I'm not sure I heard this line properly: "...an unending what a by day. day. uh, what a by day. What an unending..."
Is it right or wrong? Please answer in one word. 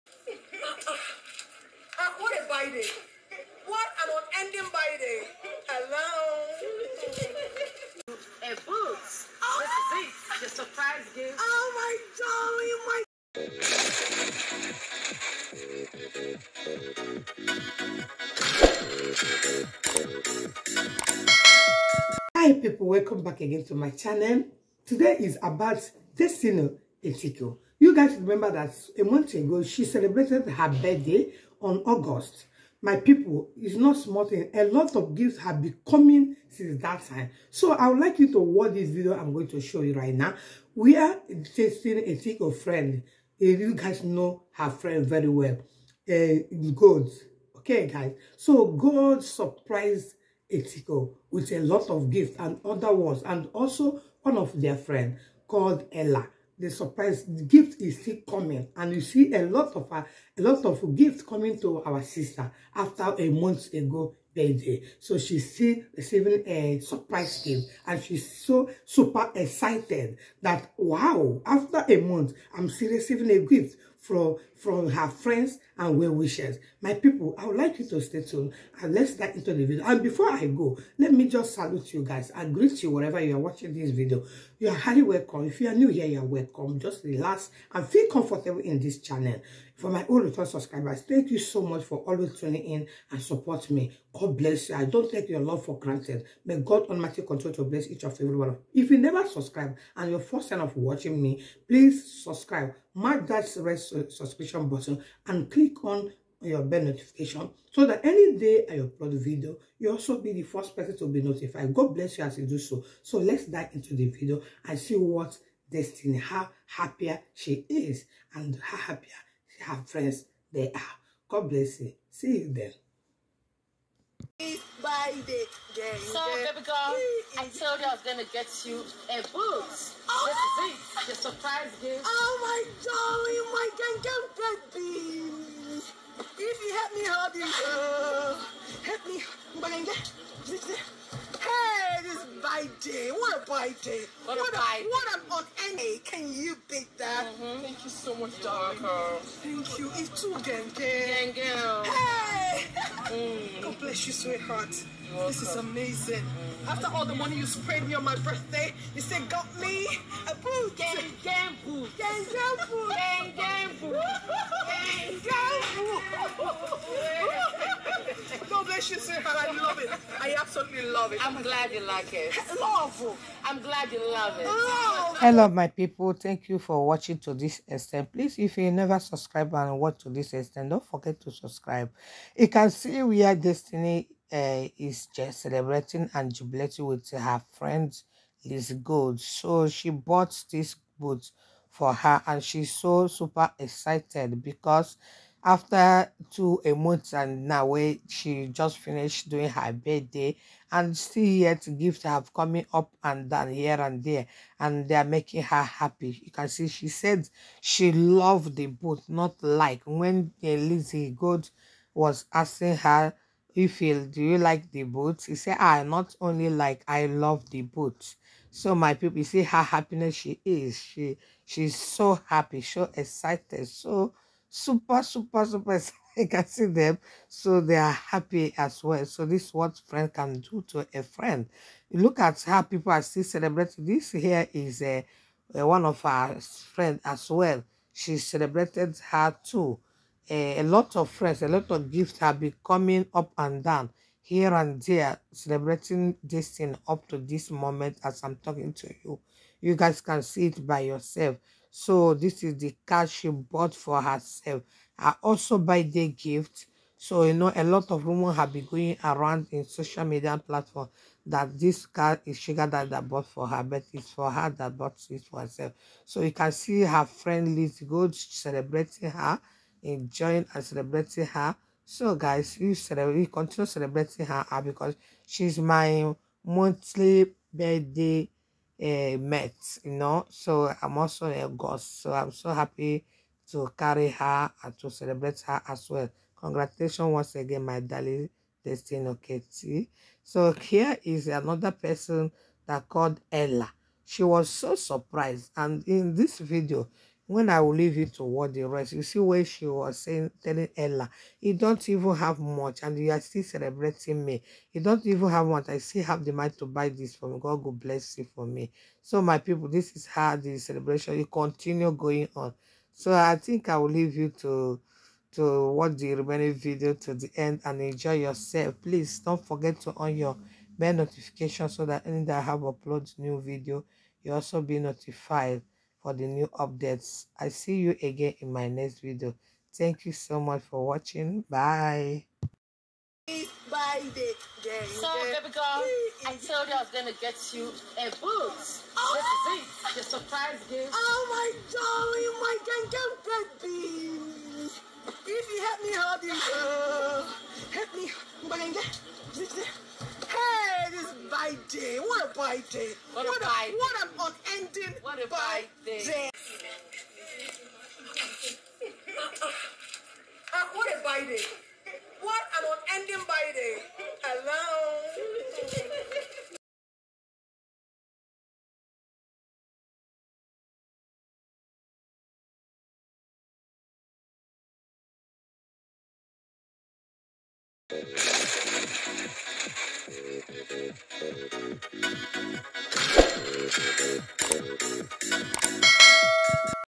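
right.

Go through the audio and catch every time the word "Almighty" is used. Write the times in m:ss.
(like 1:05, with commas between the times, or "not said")
1:36.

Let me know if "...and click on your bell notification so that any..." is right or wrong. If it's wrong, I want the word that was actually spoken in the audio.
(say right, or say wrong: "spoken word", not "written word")
right.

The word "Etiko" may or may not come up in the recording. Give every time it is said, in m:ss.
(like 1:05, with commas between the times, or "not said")
0:27, 0:50.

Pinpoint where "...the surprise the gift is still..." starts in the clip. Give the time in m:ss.
0:56.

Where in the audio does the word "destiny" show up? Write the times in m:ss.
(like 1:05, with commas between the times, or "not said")
0:26, 1:55, 3:03, 4:48.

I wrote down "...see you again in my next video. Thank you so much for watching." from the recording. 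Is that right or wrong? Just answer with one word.
right.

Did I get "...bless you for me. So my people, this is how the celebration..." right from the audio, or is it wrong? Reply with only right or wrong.
right.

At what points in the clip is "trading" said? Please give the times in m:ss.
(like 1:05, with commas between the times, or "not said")
not said.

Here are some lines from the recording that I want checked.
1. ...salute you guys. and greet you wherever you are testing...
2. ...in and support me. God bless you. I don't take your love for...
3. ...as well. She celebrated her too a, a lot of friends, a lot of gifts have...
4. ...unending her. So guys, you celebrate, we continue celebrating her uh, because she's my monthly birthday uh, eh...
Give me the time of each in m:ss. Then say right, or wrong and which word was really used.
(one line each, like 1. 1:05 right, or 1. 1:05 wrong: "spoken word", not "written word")
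1. 1:21 wrong: "watching", not "testing"
2. 1:32 right
3. 3:57 right
4. 4:30 wrong: "celebrating", not "unending".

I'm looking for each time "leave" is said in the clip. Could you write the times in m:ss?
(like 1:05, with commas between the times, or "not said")
4:57, 5:13.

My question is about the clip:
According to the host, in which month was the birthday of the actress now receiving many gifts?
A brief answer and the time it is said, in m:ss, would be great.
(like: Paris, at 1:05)
August, at 0:31.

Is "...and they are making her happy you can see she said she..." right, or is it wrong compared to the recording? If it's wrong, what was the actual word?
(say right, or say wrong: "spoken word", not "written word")
right.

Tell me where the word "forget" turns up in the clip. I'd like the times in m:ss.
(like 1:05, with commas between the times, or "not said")
3:00, 5:19.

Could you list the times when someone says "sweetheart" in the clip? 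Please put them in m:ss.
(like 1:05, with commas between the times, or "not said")
2:34, 2:48.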